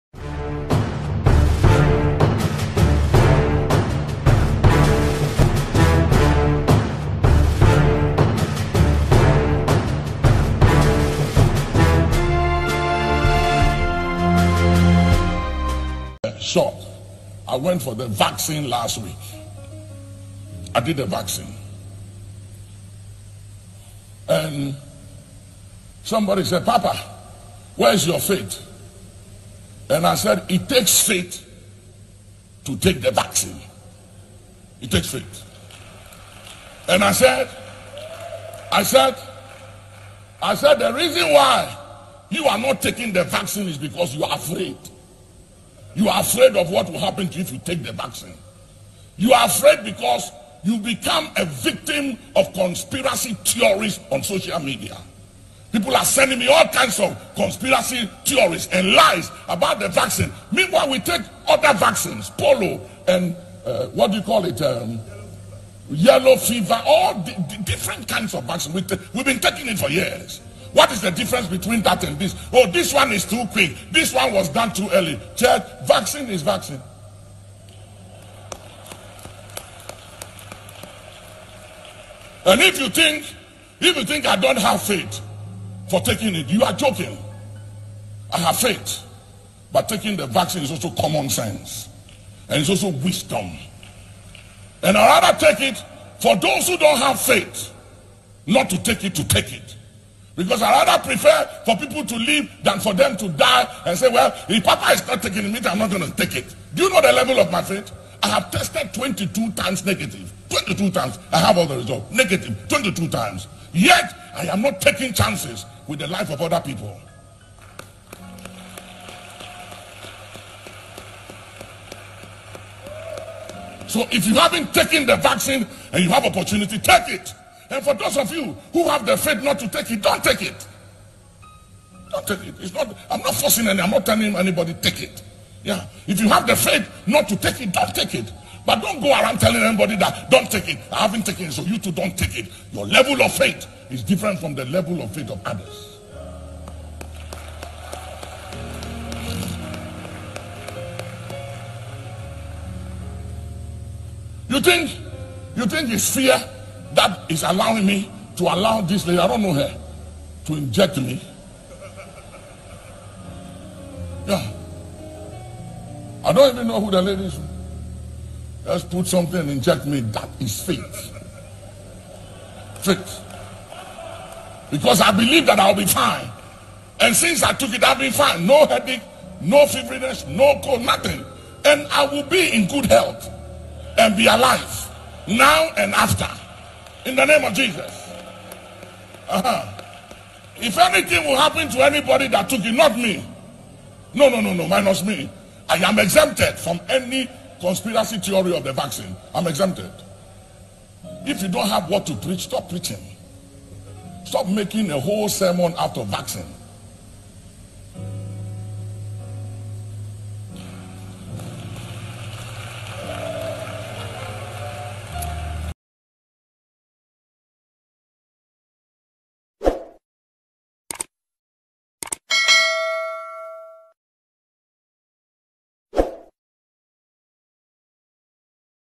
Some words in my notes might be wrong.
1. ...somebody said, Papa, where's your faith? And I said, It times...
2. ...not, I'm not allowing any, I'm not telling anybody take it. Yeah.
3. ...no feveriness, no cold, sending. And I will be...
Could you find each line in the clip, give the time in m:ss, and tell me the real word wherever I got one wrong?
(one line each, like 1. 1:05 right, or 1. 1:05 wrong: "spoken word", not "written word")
1. 0:26 wrong: "takes", not "times"
2. 2:12 wrong: "forcing", not "allowing"
3. 2:59 wrong: "nothing", not "sending".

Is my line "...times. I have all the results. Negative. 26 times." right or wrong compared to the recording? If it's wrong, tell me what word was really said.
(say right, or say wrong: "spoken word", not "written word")
wrong: "22", not "26".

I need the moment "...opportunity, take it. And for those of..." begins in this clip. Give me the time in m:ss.
2:06.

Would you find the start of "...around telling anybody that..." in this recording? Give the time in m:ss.
2:19.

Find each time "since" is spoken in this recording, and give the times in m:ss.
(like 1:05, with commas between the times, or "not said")
2:57.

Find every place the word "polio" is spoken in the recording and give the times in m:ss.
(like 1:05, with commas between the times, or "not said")
1:02.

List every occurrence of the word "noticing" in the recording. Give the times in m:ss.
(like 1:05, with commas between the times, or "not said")
not said.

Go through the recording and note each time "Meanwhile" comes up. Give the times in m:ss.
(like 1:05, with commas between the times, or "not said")
1:00.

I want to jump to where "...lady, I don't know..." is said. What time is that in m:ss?
2:39.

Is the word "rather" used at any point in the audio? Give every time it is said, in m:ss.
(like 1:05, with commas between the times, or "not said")
1:35, 1:40.